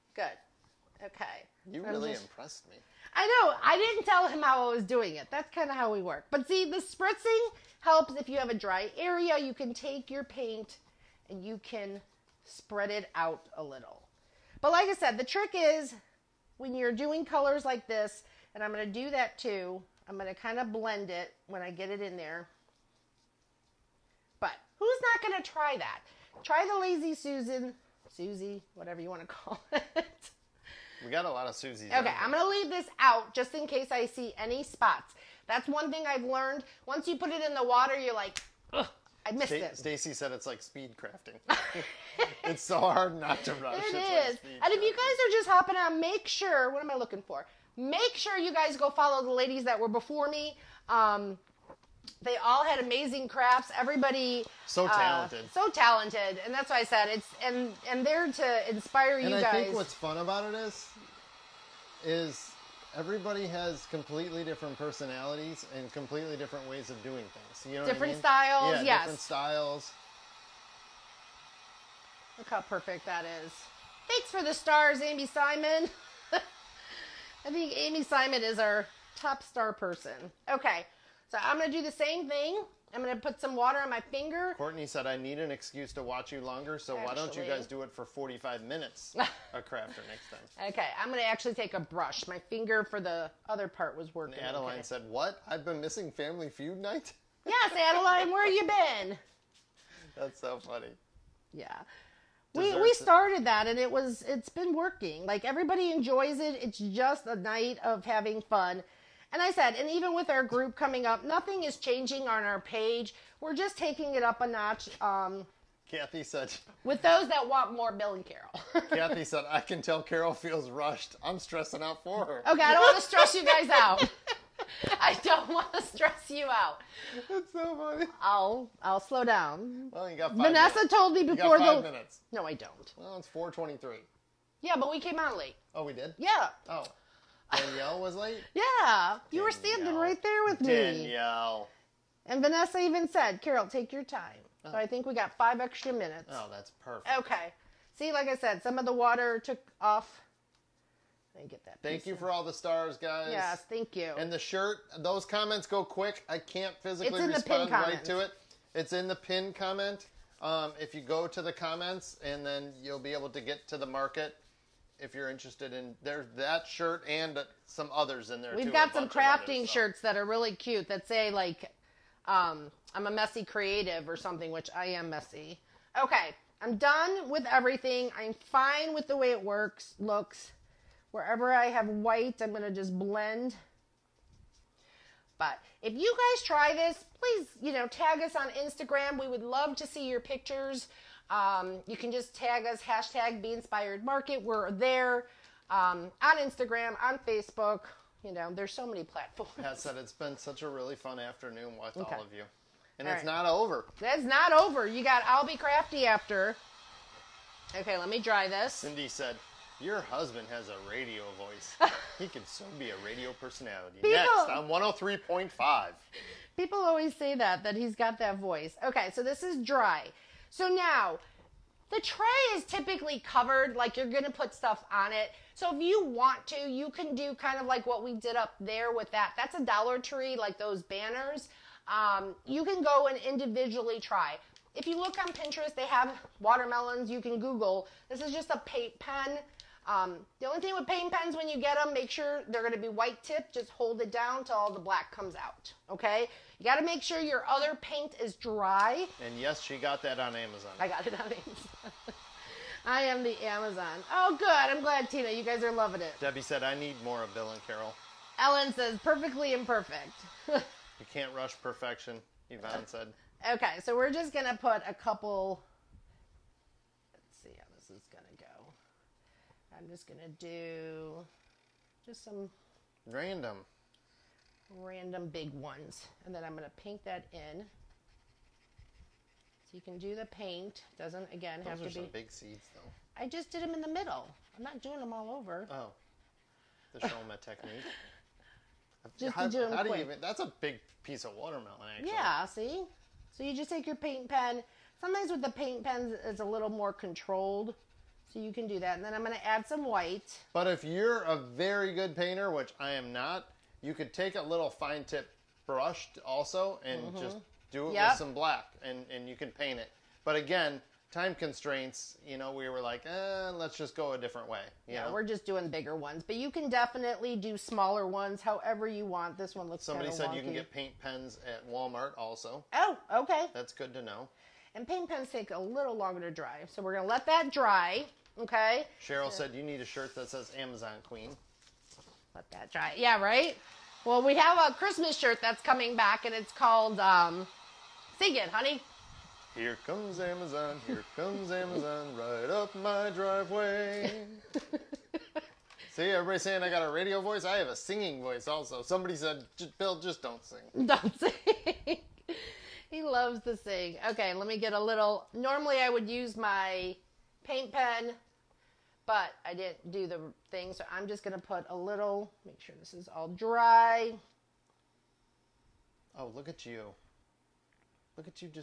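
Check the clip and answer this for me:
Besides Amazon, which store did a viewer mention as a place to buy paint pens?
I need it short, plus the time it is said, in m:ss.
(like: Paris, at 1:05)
Walmart, at 5:21.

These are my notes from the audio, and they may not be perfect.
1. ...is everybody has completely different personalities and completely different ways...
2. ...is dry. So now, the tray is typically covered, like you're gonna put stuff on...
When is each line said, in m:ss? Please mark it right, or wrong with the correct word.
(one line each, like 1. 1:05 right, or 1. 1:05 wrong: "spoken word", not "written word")
1. 1:02 right
2. 3:39 right.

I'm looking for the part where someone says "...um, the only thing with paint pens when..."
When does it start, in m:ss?
3:59.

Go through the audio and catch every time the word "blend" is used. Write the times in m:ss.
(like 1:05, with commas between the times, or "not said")
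0:20, 3:02.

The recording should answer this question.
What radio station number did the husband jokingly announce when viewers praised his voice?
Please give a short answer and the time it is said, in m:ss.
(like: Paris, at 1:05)
103.5, at 3:34.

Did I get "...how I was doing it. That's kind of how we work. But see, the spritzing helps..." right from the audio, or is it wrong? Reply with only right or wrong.
right.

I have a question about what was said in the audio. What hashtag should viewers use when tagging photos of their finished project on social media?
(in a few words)
Be Inspired Market.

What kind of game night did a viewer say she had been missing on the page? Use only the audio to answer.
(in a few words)
Family Feud.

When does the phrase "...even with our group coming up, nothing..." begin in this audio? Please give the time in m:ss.
1:49.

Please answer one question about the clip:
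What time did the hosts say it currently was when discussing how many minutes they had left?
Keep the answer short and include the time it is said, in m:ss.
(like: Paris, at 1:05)
4:23, at 2:13.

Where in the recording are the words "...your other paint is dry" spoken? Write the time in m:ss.
4:07.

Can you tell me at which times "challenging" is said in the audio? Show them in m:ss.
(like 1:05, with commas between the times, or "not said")
not said.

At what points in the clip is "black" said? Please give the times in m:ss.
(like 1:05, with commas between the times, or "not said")
4:04, 5:08.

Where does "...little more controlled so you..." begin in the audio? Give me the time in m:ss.
4:56.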